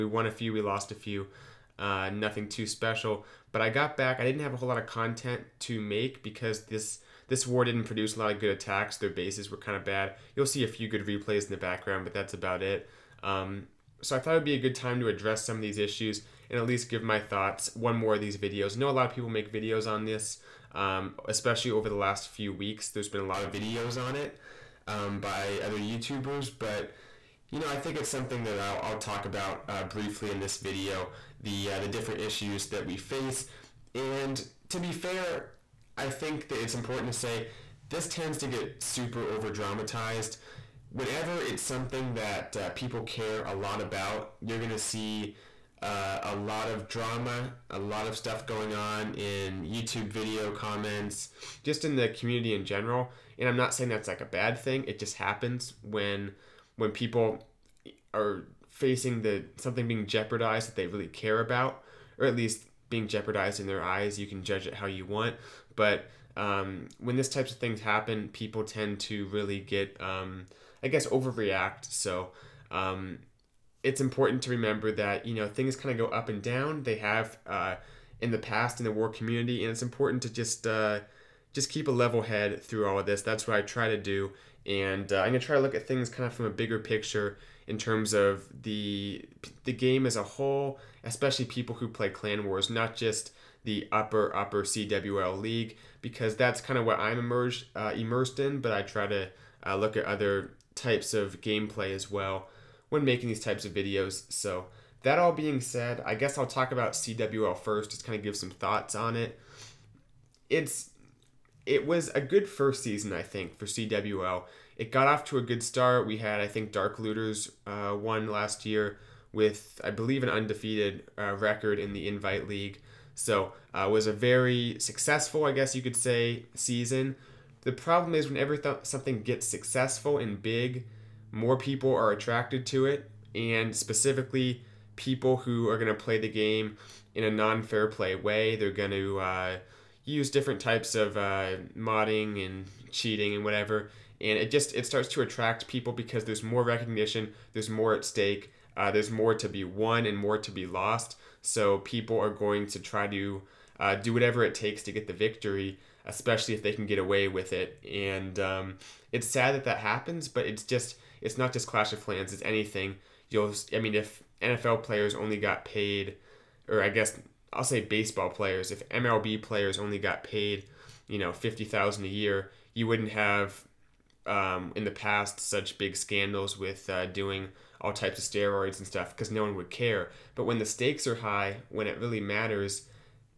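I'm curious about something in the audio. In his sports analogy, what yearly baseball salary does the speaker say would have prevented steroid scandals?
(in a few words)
$50,000.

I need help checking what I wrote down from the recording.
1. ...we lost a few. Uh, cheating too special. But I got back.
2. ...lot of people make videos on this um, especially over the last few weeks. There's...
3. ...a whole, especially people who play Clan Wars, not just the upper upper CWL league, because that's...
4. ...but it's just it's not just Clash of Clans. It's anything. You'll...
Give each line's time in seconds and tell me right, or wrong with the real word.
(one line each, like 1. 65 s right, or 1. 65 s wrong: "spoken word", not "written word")
1. 0 s wrong: "nothing", not "cheating"
2. 18 s right
3. 90 s right
4. 160 s right.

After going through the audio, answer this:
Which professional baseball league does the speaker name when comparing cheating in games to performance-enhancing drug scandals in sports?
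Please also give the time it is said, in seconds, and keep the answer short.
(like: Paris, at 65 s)
MLB, at 168 s.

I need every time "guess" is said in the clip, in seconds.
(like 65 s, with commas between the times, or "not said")
70 s, 106 s, 125 s, 166 s.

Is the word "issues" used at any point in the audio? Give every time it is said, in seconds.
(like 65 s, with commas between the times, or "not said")
15 s, 32 s.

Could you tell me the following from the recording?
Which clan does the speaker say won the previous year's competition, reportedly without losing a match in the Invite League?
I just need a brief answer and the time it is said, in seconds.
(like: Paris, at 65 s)
Dark Looters, at 116 s.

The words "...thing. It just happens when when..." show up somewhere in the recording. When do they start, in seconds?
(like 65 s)
54 s.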